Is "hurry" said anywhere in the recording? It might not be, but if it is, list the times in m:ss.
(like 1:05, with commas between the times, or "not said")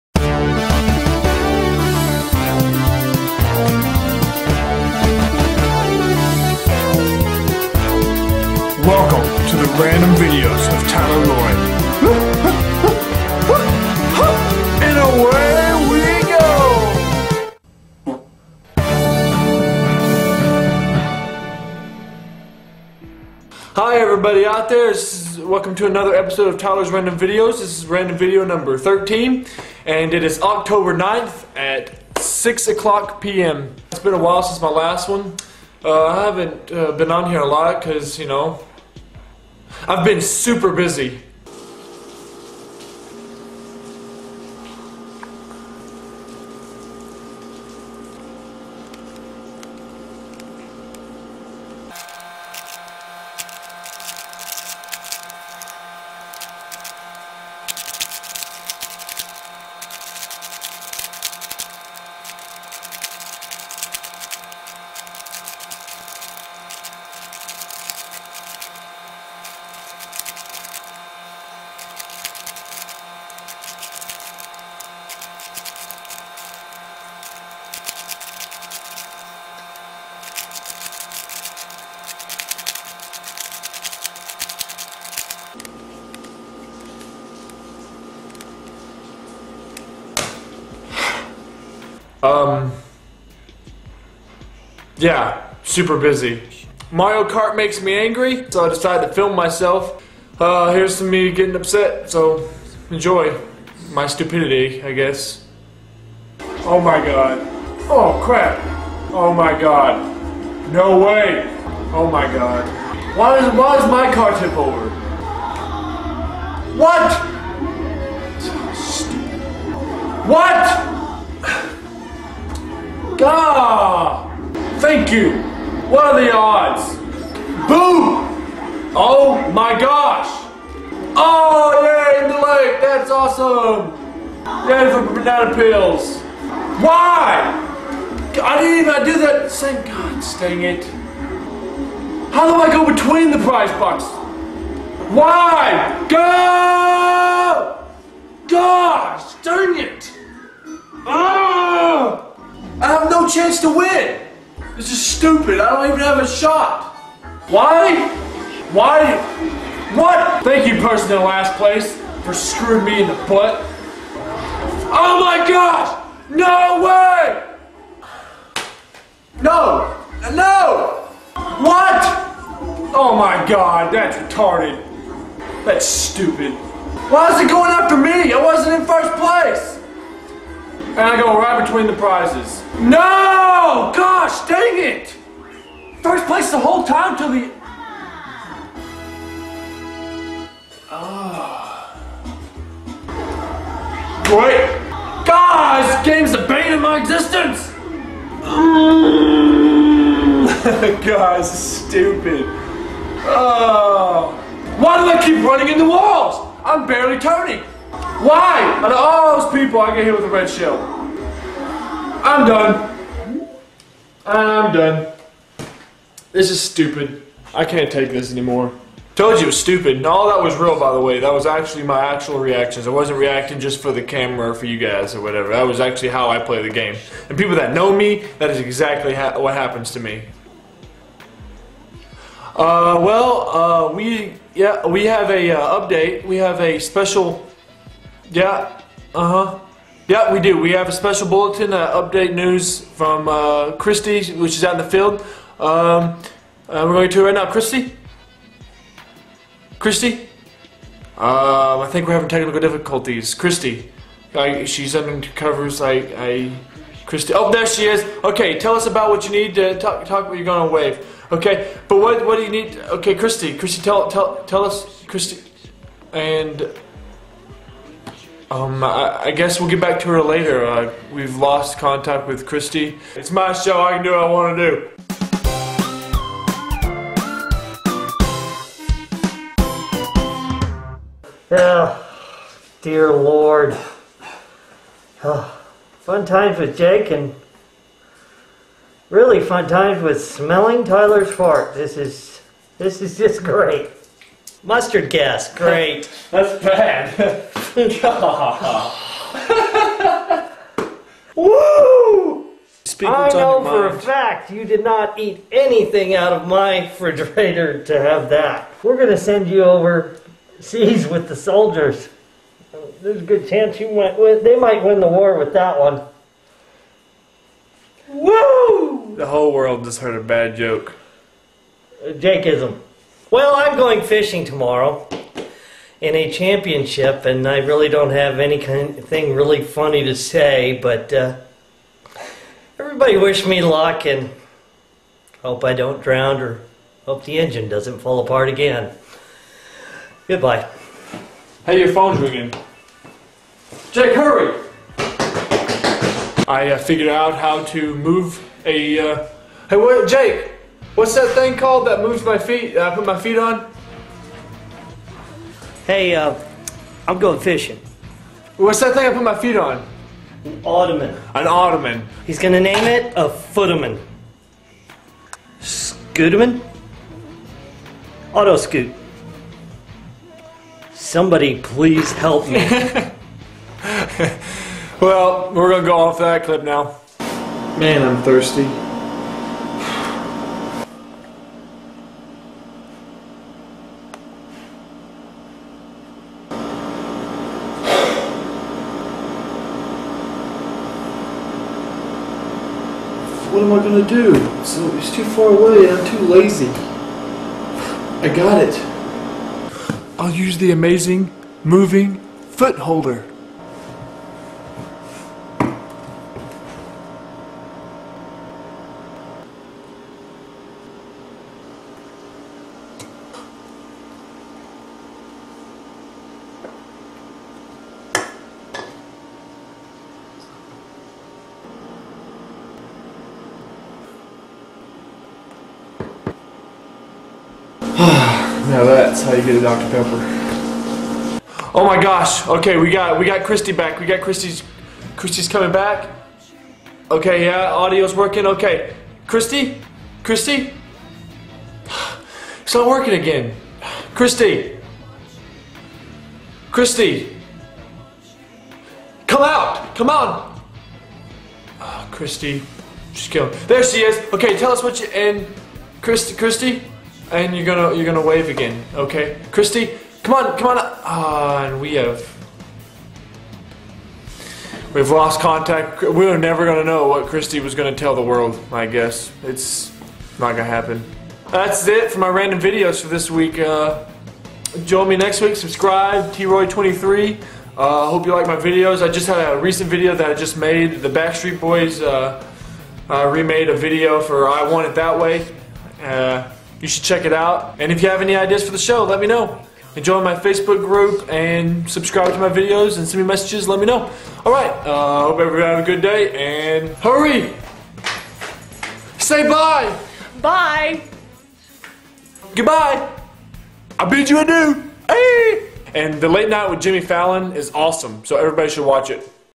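5:44, 8:16.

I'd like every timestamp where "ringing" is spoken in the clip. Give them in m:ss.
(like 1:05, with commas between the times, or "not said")
5:42.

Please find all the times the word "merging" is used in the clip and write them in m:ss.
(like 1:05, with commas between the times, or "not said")
not said.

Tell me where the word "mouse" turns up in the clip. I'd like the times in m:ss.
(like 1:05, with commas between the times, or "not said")
not said.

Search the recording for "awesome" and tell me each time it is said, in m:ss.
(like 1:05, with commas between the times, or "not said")
2:13, 8:27.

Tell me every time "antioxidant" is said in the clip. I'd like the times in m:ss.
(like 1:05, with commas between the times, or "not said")
not said.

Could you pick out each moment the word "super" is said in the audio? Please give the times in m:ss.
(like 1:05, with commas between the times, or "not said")
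0:40, 1:35.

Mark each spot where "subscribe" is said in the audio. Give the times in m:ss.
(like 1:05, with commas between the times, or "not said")
7:55, 8:11.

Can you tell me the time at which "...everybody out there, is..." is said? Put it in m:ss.
0:23.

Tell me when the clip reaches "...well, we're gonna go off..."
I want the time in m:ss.
6:15.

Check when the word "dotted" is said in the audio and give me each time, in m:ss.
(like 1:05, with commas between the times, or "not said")
not said.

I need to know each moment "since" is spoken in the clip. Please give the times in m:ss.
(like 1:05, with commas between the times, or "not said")
0:34.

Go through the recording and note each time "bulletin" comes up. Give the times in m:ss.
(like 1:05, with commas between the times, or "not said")
4:01.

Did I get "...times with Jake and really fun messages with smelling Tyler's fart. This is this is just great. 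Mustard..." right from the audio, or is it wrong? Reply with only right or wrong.
wrong.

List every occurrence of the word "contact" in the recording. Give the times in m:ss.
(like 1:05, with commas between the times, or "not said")
4:31, 7:45.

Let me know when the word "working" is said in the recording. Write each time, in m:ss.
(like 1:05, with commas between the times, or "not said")
7:18, 7:22.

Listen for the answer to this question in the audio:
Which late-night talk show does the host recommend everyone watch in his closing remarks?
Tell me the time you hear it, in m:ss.
8:26.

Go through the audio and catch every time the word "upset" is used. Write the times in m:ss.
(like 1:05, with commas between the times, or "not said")
1:41.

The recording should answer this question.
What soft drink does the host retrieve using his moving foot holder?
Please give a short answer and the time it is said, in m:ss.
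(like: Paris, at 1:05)
Dr. Pepper, at 7:09.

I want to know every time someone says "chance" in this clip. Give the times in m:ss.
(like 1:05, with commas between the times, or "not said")
2:33, 5:13.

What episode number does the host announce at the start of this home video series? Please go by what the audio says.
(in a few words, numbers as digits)
13.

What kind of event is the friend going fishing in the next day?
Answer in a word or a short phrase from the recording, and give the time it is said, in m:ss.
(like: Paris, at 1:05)
a championship, at 5:26.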